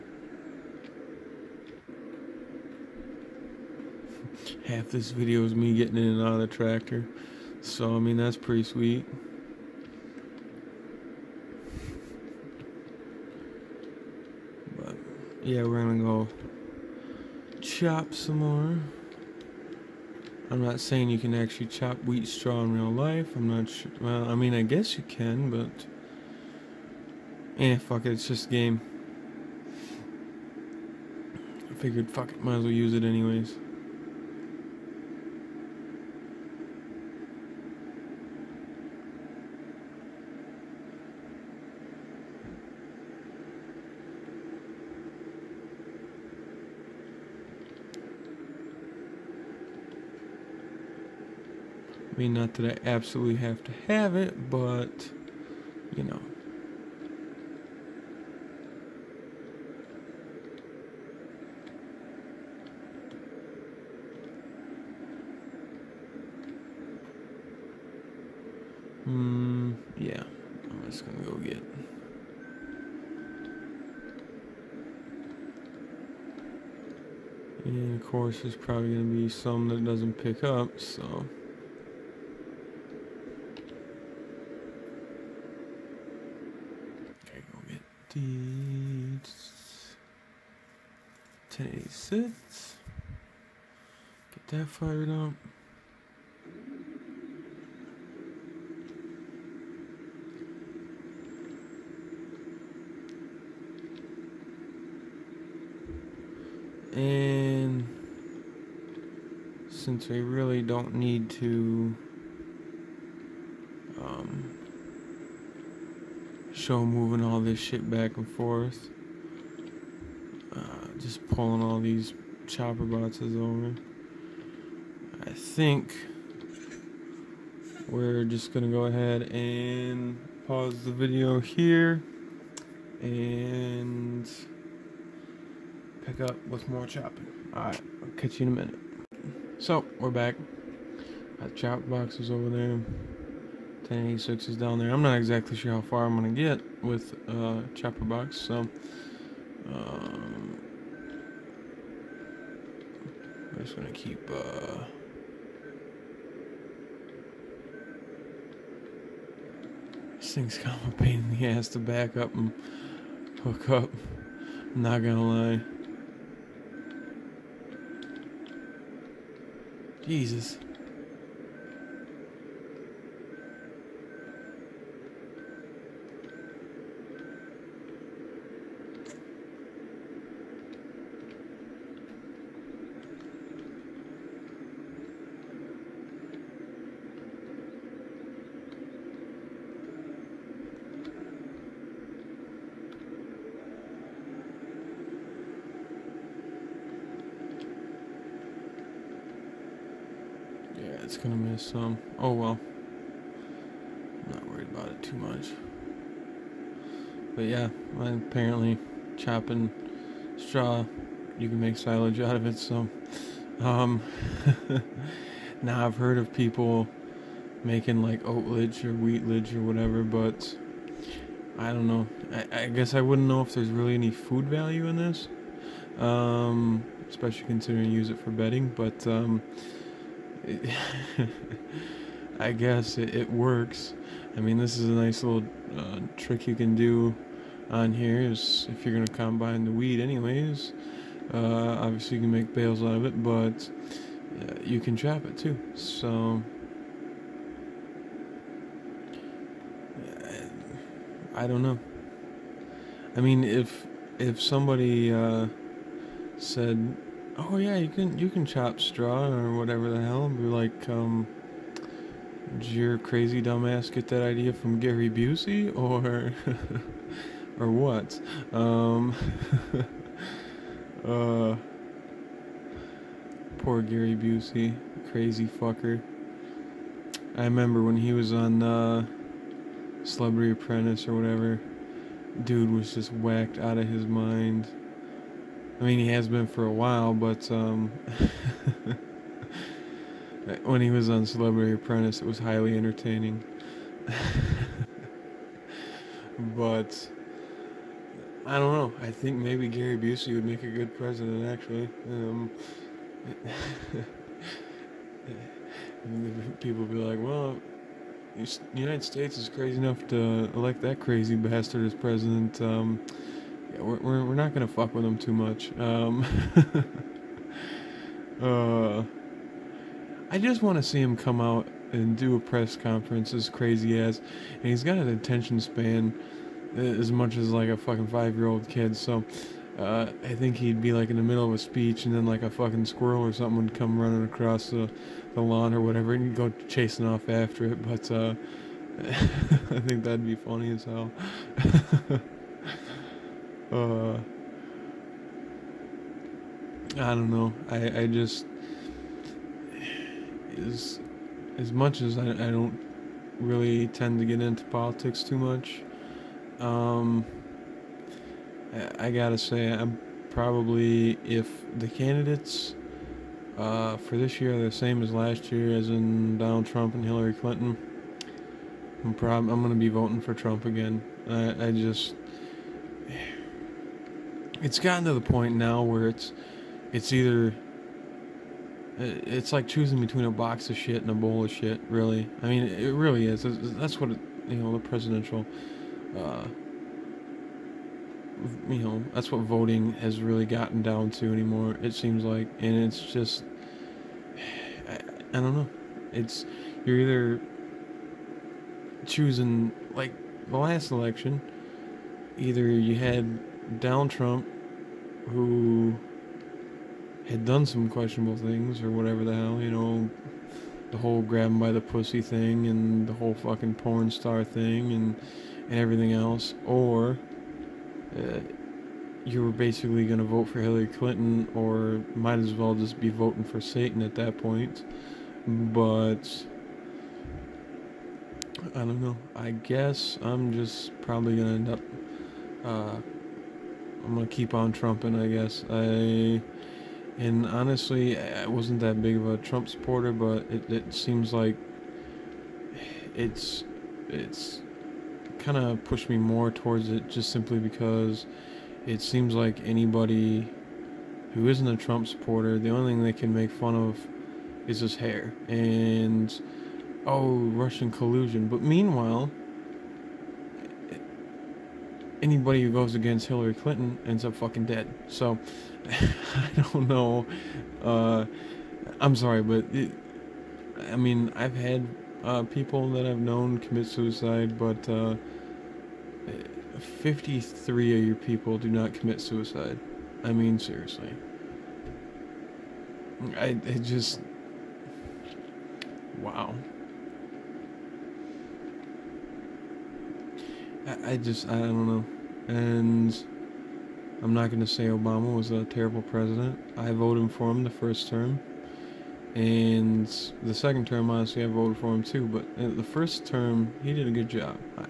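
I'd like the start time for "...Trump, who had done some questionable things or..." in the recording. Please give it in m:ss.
6:44.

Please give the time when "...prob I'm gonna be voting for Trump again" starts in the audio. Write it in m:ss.
6:09.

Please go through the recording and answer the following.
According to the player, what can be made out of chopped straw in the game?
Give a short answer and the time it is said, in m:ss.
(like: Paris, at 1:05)
Silage, at 3:31.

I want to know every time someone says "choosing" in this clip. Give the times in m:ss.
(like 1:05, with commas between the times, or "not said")
6:19, 6:39.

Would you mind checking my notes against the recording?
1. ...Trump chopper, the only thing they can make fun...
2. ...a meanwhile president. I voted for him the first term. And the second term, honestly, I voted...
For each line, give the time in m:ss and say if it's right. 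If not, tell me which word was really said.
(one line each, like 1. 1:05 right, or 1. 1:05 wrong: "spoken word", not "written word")
1. 7:31 wrong: "supporter", not "chopper"
2. 8:15 wrong: "terrible", not "meanwhile".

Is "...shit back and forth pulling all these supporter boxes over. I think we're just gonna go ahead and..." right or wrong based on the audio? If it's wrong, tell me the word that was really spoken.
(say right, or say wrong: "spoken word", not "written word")
wrong: "chopper", not "supporter".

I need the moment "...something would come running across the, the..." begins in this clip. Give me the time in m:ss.
5:33.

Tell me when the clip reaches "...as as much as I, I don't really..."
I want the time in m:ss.
5:50.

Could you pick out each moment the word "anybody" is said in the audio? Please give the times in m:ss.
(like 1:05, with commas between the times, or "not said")
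7:29, 7:42.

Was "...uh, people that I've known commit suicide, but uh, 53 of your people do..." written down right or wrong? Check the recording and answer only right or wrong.
right.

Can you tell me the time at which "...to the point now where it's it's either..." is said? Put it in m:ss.
6:15.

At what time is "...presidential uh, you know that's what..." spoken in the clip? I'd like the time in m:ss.
6:24.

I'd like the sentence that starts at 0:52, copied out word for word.
I mean, not that I absolutely have to have it, but, you know.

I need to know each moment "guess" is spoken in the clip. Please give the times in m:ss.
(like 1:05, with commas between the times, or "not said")
0:24, 3:42, 3:52, 7:09, 7:15.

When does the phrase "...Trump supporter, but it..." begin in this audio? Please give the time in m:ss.
7:19.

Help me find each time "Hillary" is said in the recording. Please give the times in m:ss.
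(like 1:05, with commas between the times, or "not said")
6:07, 7:00, 7:43.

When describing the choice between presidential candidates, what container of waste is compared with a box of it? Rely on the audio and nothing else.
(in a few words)
Bowl.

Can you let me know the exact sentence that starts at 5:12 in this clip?
Um, we're, we're, we're not gonna fuck with him too much.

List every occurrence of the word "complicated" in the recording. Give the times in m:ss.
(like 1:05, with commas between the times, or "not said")
not said.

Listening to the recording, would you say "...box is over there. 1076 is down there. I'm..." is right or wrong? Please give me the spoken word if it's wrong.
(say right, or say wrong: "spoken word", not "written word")
wrong: "1086", not "1076".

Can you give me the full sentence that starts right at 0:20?
I'm not saying you can actually chop wheat straw in real life.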